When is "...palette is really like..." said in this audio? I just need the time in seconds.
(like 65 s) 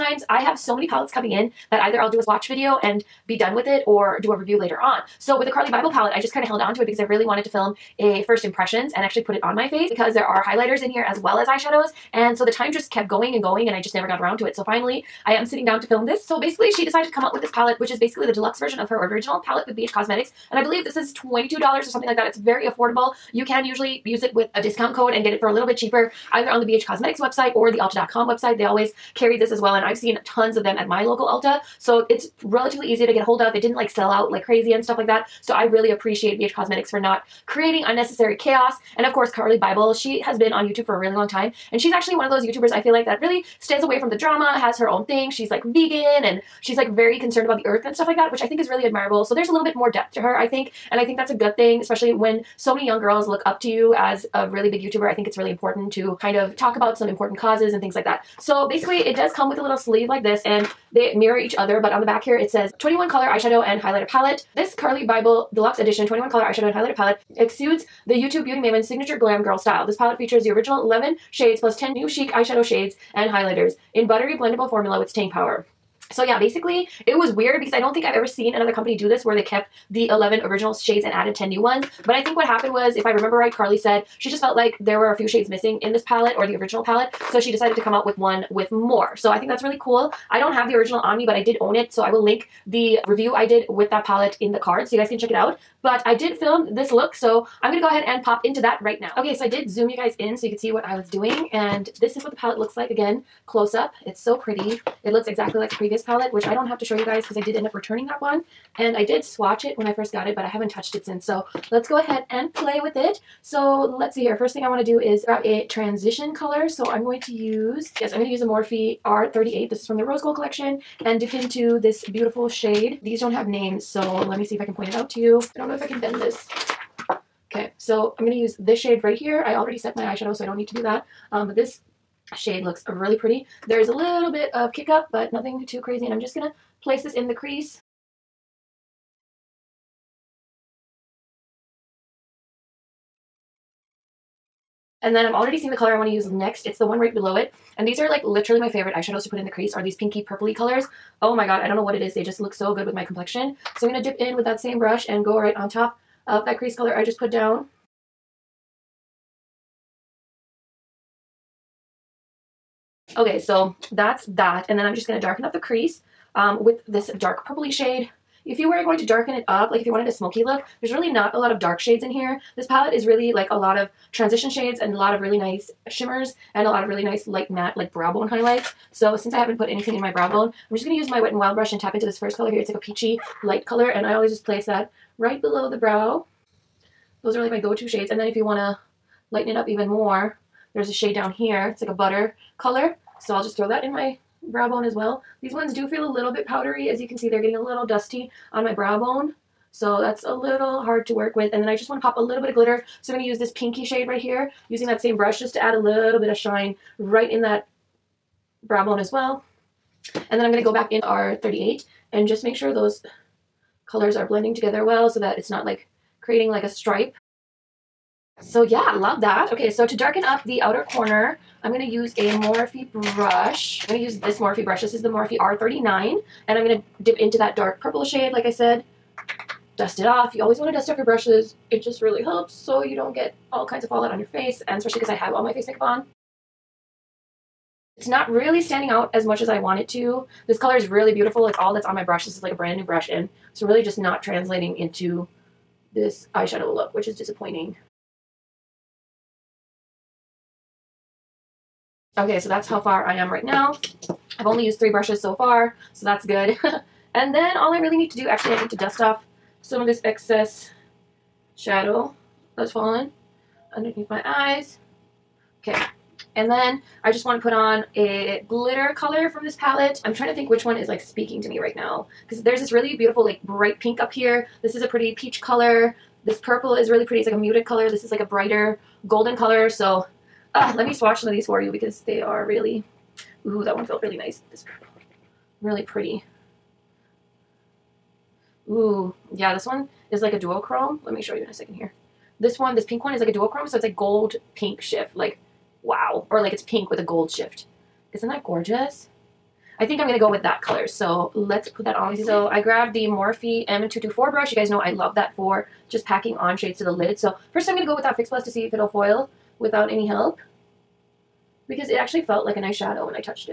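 172 s.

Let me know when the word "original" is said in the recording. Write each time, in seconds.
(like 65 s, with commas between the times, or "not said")
19 s, 70 s, 80 s, 86 s, 90 s.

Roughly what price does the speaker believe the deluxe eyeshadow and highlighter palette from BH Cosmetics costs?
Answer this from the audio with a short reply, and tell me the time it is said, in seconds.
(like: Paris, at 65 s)
$22, at 21 s.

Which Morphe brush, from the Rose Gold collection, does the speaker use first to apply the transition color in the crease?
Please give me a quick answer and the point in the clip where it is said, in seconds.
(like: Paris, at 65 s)
R38, at 118 s.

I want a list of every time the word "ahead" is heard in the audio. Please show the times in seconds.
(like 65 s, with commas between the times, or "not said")
97 s, 111 s.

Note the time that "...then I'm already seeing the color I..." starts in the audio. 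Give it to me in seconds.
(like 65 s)
145 s.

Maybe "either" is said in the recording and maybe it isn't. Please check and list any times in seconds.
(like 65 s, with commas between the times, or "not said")
1 s, 26 s.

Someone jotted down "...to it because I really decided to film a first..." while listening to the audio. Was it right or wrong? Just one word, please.
wrong.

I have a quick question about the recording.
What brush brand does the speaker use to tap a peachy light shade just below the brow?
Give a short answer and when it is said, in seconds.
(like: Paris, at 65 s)
Wet n Wild, at 181 s.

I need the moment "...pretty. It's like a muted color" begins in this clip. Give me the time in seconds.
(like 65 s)
277 s.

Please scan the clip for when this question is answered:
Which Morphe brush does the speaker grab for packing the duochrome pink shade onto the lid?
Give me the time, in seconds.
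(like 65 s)
303 s.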